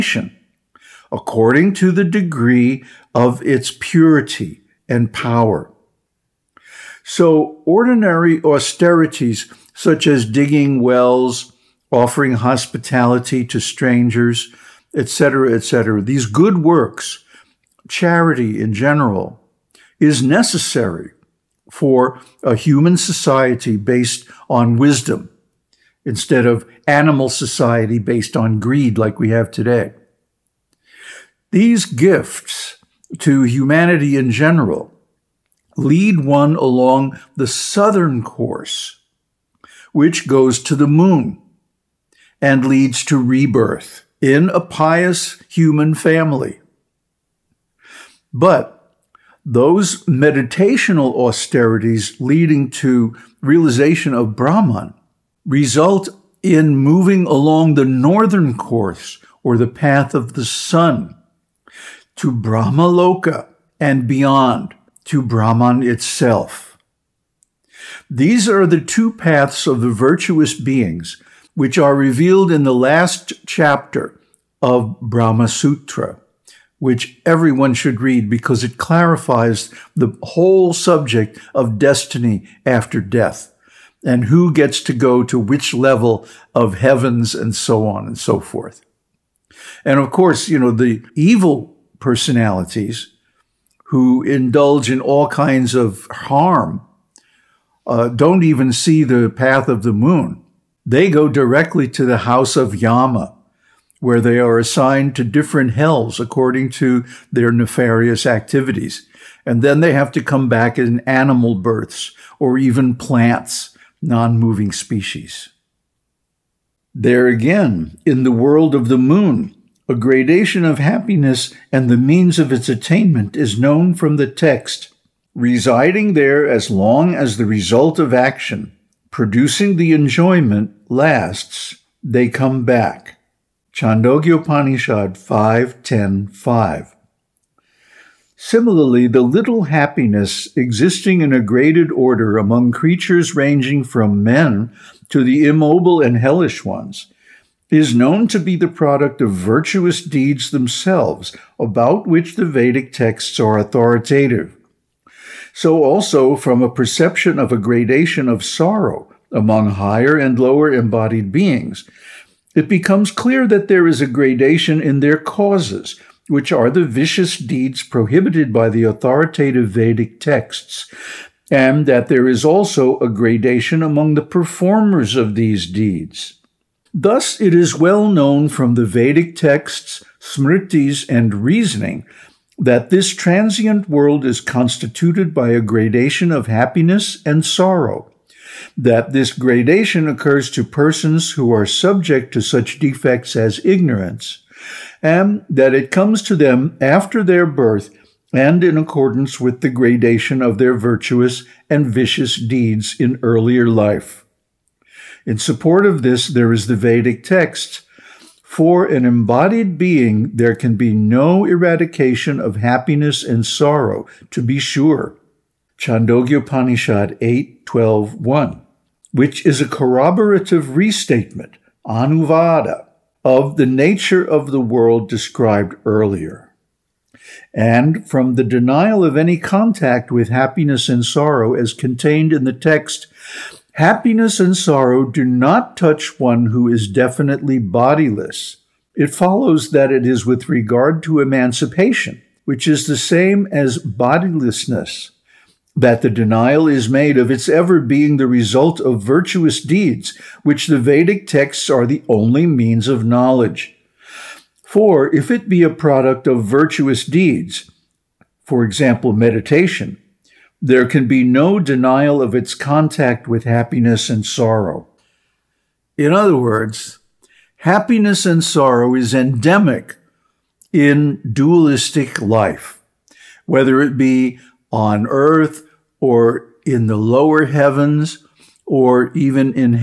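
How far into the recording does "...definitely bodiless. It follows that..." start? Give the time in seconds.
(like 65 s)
236 s.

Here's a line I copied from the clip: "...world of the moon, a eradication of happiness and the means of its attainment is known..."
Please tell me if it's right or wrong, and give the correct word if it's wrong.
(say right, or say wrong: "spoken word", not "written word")
wrong: "gradation", not "eradication".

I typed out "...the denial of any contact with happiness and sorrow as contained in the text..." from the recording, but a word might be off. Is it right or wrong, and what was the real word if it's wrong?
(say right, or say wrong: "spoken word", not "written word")
right.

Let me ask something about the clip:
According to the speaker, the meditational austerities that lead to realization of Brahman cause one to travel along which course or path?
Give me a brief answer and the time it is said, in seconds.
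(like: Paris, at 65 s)
Northern course, at 57 s.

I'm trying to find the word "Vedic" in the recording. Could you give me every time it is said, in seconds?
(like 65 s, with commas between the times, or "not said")
152 s, 169 s, 178 s, 206 s, 250 s.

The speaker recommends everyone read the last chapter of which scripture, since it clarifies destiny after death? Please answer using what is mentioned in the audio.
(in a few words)
Brahma Sutra.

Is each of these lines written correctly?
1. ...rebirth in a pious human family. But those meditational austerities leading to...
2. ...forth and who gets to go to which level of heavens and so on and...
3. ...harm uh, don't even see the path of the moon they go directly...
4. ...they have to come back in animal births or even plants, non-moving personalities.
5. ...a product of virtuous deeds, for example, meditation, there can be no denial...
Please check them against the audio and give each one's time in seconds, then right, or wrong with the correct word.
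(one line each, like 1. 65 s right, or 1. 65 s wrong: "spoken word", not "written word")
1. 43 s right
2. 83 s wrong: "death", not "forth"
3. 96 s right
4. 109 s wrong: "species", not "personalities"
5. 255 s right.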